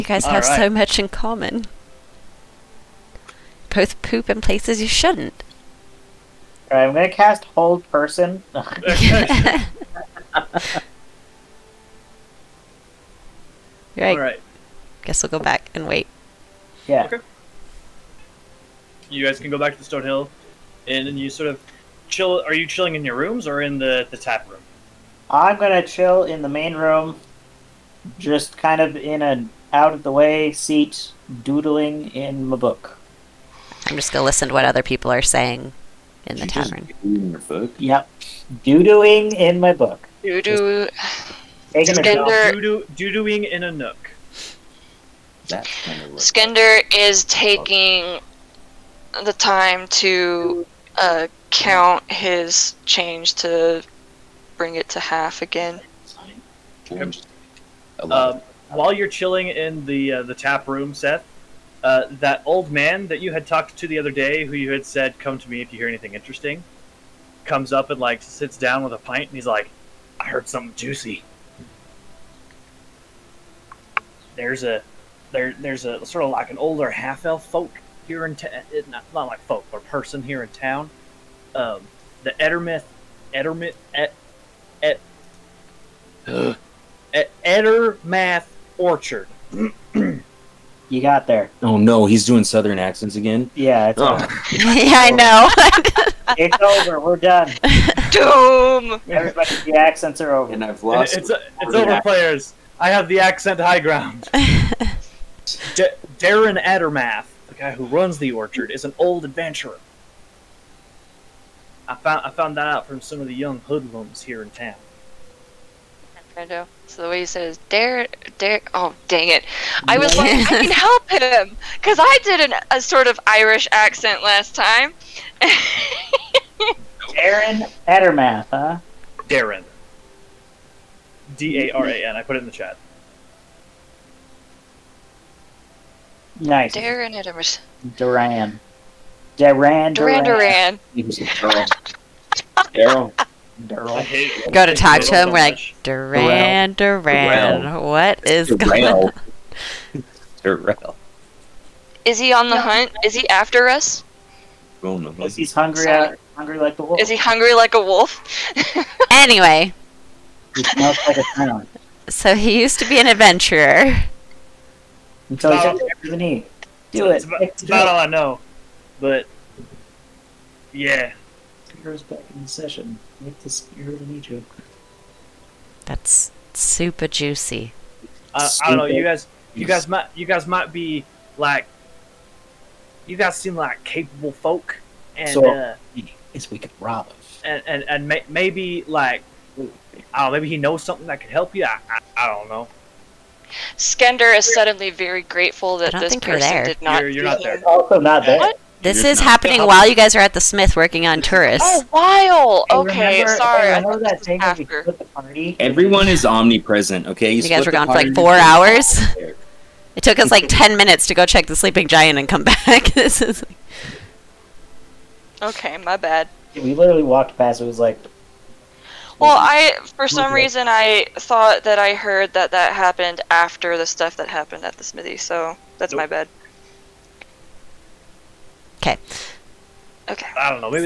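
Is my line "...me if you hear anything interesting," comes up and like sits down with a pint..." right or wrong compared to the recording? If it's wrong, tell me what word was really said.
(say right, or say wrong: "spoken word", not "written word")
right.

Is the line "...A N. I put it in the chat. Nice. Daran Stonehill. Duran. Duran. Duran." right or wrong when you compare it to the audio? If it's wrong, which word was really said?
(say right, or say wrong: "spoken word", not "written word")
wrong: "Edermath", not "Stonehill".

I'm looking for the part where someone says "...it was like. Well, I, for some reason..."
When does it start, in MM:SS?
03:37.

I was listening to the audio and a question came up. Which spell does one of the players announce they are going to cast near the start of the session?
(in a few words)
Hold Person.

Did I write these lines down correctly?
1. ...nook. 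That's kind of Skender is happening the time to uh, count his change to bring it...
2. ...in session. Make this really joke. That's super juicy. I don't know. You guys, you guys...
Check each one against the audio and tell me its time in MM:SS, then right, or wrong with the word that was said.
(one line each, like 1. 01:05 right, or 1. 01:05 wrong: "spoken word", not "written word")
1. 00:43 wrong: "taking", not "happening"
2. 02:52 right.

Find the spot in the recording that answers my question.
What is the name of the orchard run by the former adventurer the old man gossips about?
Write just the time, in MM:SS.
01:27.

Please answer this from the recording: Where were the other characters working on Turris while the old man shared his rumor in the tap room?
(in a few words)
The Smith.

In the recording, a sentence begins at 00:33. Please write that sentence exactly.
I'm just gonna listen to what other people are saying in the tavern.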